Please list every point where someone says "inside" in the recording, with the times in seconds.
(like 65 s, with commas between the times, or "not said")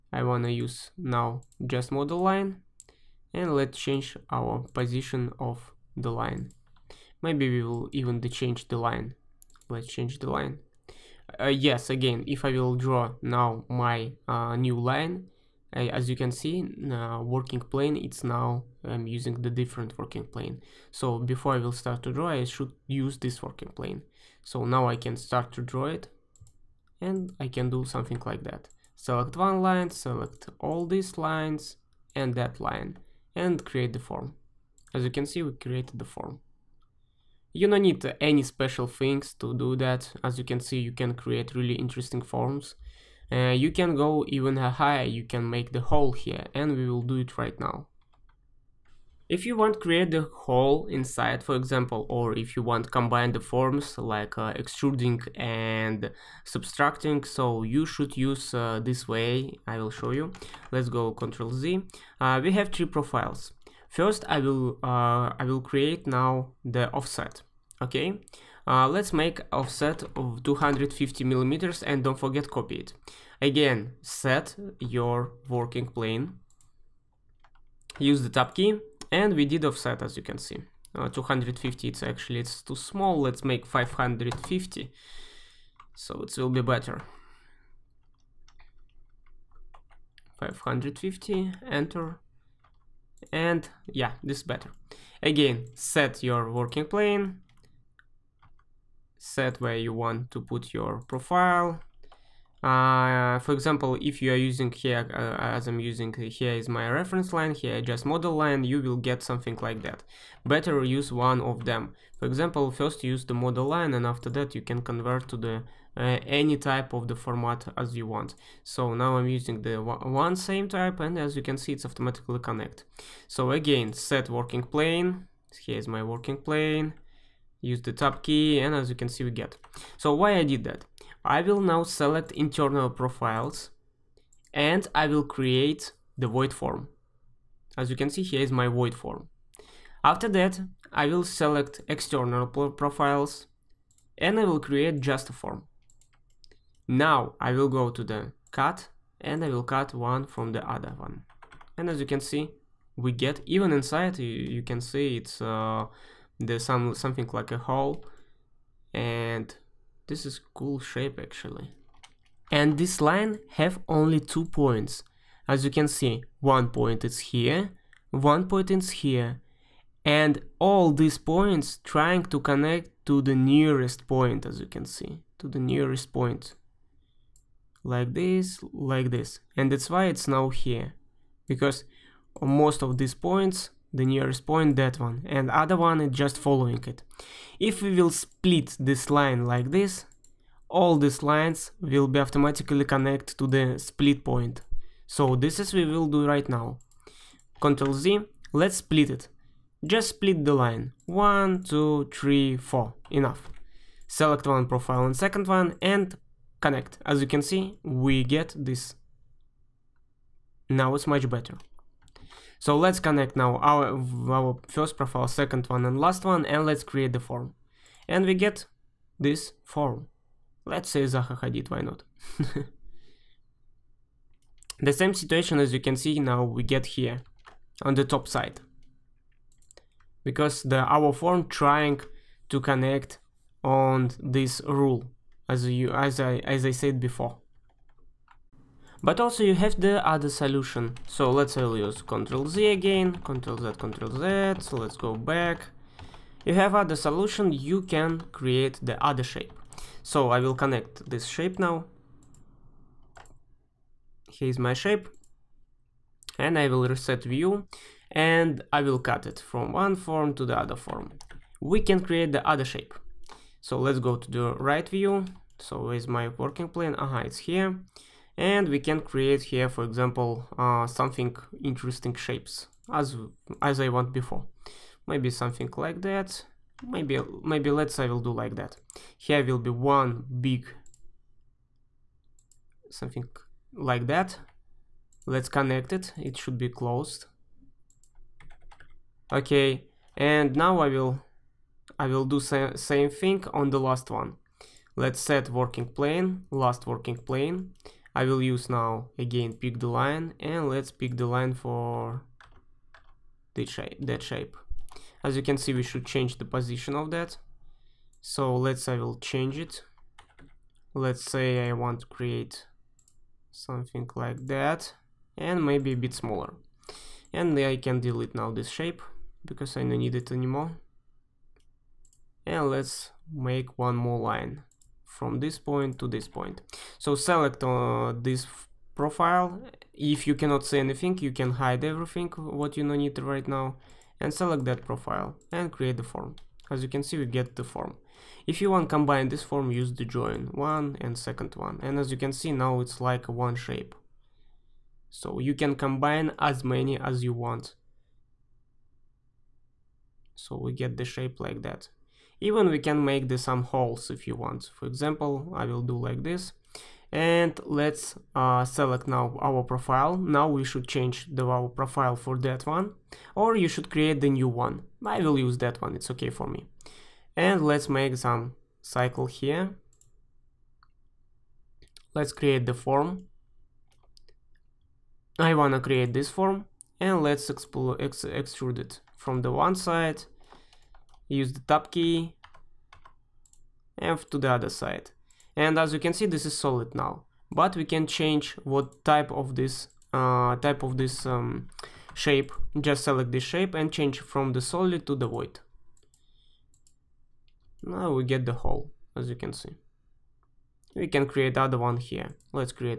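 50 s, 153 s.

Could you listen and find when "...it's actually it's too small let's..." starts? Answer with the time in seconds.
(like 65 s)
81 s.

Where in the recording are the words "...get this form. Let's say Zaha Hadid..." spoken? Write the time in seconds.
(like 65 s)
218 s.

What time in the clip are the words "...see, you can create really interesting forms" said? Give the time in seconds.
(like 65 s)
40 s.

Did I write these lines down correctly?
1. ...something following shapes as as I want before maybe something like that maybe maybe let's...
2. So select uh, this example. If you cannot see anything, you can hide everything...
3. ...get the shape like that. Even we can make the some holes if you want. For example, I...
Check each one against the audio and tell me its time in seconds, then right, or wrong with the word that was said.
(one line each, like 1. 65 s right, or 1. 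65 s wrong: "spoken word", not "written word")
1. 270 s wrong: "interesting", not "following"
2. 326 s wrong: "profile", not "example"
3. 350 s right.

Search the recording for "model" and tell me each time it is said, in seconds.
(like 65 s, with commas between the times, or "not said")
1 s, 108 s, 113 s.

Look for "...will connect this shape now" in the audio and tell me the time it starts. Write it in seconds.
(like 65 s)
250 s.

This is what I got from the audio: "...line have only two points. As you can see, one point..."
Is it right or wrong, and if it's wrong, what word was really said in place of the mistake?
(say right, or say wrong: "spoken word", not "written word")
right.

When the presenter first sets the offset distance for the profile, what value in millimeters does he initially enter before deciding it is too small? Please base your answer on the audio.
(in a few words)
250.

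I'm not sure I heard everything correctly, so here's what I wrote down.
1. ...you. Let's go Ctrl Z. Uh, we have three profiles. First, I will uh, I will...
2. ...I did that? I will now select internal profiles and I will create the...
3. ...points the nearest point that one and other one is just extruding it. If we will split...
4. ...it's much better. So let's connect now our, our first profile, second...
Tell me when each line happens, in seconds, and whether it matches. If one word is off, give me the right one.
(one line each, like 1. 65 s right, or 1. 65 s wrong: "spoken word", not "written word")
1. 60 s right
2. 130 s right
3. 183 s wrong: "following", not "extruding"
4. 210 s right.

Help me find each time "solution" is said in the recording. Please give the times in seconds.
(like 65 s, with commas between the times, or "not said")
240 s, 246 s.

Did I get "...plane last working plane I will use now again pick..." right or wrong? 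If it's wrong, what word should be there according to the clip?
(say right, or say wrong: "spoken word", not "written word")
right.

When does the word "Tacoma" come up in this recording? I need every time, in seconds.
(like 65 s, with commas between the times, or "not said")
not said.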